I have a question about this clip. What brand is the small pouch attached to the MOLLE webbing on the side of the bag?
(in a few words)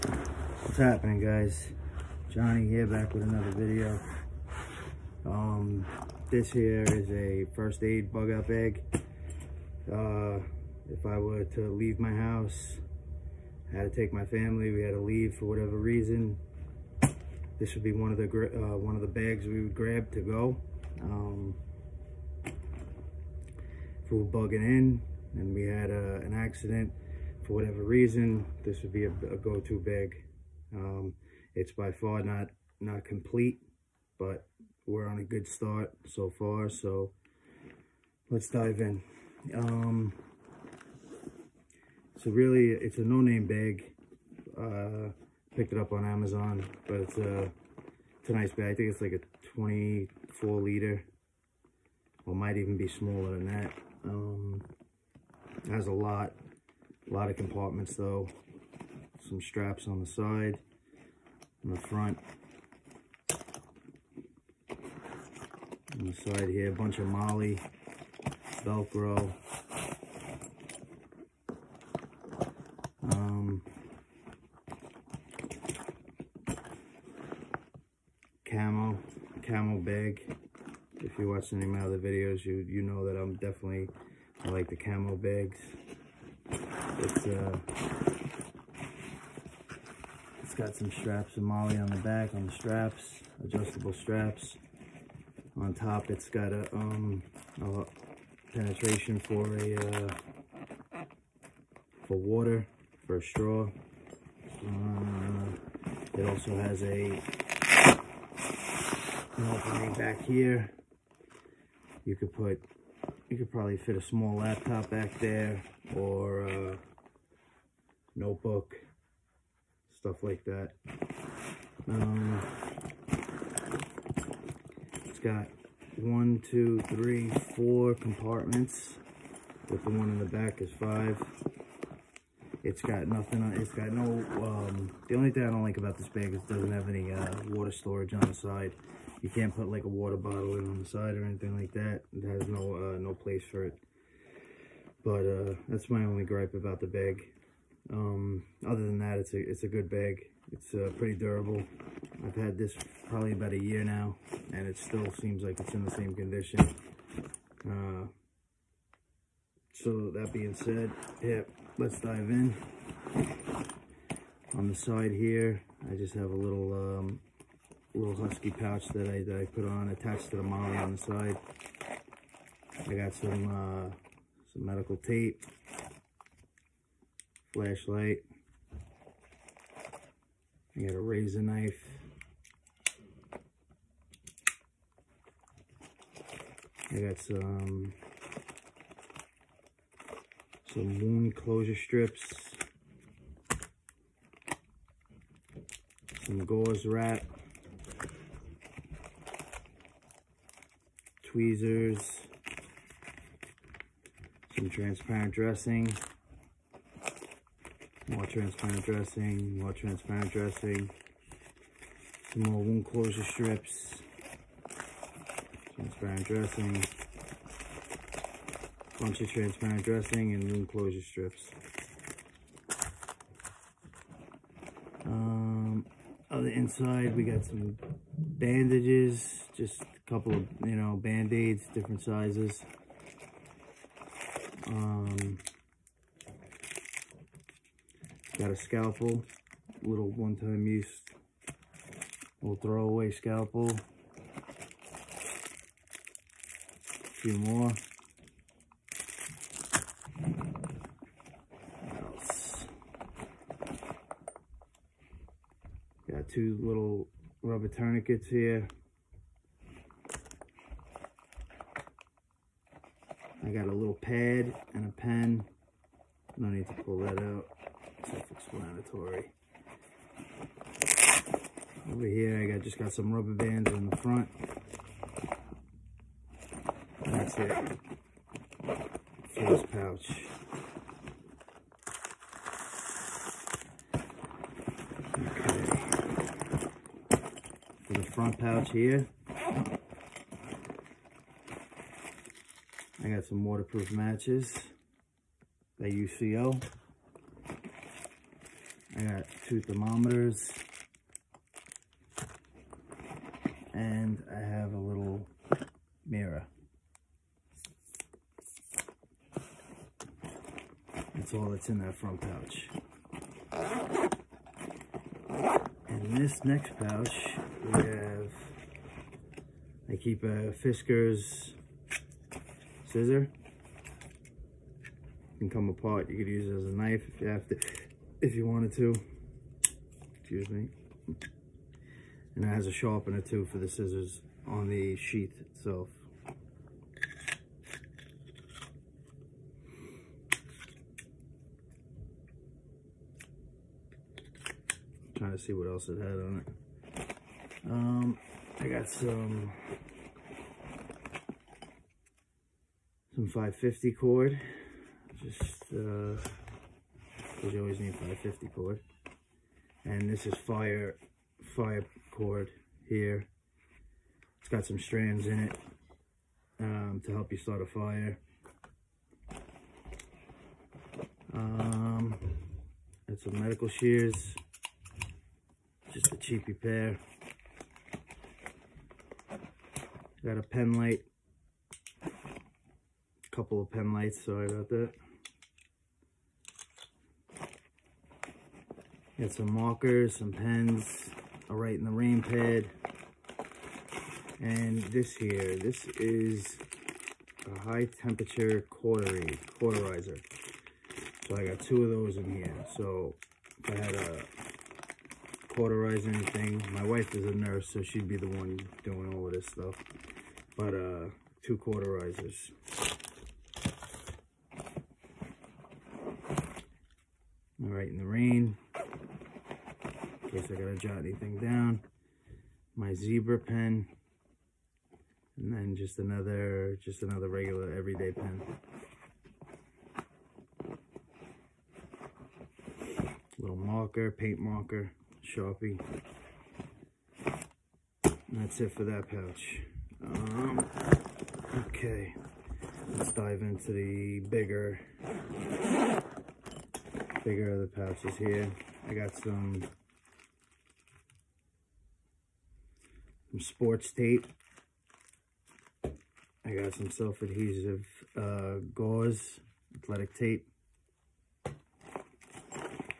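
Husky.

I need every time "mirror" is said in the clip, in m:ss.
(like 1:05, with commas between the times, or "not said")
5:06.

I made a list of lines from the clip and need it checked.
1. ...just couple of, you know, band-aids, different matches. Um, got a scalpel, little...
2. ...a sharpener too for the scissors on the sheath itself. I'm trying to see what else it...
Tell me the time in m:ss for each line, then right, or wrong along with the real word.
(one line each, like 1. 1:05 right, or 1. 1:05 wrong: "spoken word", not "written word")
1. 3:49 wrong: "sizes", not "matches"
2. 5:32 right.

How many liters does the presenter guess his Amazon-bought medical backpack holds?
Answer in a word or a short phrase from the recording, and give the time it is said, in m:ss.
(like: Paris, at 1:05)
24 liters, at 0:49.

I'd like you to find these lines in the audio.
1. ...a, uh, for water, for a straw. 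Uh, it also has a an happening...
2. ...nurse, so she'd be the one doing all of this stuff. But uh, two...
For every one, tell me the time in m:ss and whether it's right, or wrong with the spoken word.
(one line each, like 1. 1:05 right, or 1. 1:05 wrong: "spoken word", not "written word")
1. 1:39 wrong: "opening", not "happening"
2. 6:47 right.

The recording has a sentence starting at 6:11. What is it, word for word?
Um, and some medical shears, just a cheapy pair.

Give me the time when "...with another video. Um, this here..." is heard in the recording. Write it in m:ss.
0:03.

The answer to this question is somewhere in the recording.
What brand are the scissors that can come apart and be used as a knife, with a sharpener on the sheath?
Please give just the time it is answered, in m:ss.
5:20.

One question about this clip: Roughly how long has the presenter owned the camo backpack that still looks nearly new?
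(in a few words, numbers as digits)
About a year.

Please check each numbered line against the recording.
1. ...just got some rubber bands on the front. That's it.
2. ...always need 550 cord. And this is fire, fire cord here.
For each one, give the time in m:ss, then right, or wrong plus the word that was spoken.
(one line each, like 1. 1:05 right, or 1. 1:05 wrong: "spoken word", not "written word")
1. 4:32 right
2. 5:57 right.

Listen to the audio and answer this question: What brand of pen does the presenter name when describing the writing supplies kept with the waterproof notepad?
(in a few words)
Zebra.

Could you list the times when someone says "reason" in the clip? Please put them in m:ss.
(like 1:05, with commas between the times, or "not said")
0:15, 0:27.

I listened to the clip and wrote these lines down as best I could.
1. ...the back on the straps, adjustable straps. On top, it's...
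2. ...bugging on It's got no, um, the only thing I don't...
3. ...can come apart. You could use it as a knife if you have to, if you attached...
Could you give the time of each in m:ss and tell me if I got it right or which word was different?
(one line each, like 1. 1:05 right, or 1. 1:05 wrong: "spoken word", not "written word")
1. 1:31 right
2. 2:13 wrong: "nothing", not "bugging"
3. 5:25 wrong: "wanted", not "attached".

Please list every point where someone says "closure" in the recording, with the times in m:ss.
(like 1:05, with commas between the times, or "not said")
3:11, 3:32, 3:40.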